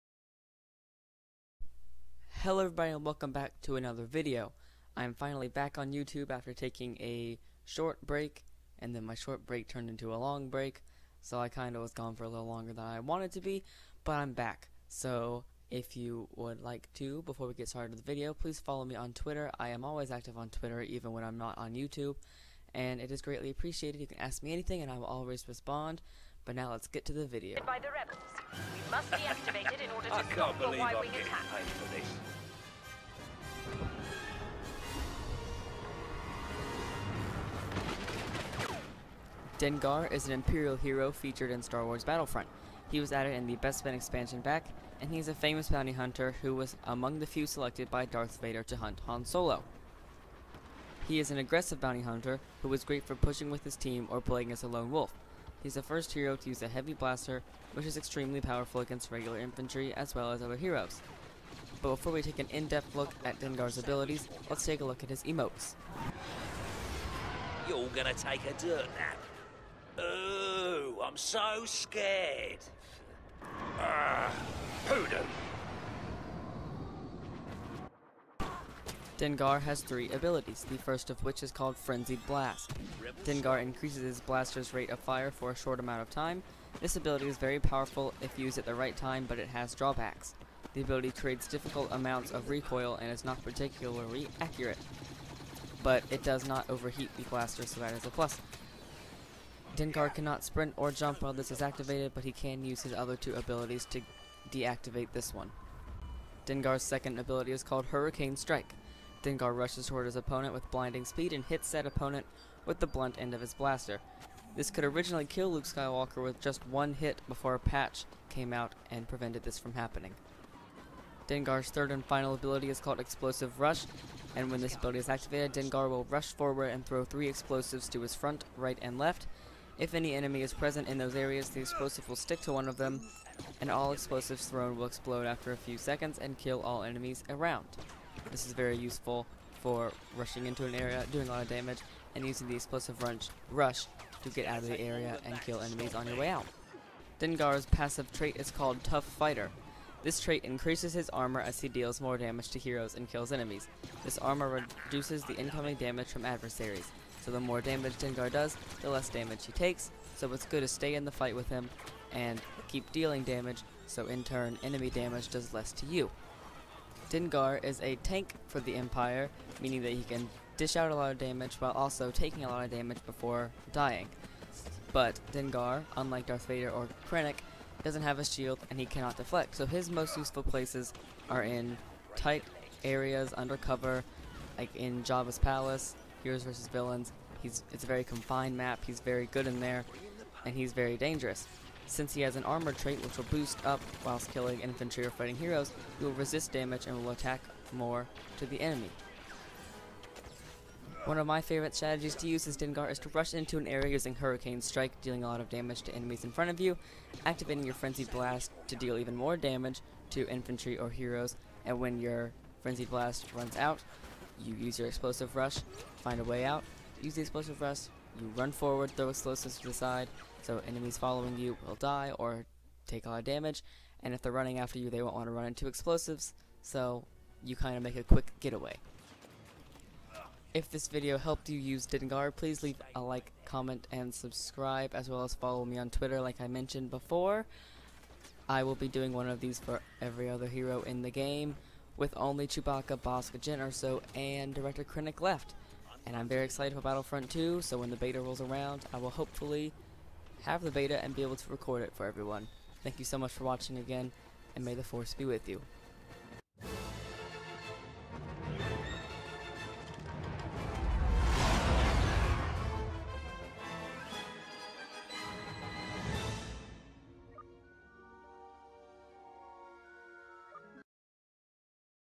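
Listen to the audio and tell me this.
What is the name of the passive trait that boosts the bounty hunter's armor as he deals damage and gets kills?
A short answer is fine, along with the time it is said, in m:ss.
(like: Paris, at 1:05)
Tough Fighter, at 2:28.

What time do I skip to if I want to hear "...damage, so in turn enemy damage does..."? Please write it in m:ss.
2:43.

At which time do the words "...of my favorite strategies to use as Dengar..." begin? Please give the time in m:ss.
3:21.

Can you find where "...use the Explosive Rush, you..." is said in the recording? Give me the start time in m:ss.
3:37.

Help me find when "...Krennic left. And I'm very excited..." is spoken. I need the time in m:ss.
4:04.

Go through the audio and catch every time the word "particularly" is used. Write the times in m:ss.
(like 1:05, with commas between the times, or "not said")
1:33.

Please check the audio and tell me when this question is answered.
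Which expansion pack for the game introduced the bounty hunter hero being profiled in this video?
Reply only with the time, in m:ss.
0:43.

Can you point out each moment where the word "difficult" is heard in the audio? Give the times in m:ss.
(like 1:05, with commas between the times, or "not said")
1:31.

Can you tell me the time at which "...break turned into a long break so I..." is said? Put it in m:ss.
0:09.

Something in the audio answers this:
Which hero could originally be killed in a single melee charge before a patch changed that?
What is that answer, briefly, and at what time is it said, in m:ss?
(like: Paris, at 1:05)
Luke Skywalker, at 1:55.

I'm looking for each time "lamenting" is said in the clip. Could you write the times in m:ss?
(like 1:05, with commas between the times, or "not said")
not said.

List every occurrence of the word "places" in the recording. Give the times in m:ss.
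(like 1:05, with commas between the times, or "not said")
3:00.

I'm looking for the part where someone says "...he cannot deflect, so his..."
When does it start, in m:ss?
2:58.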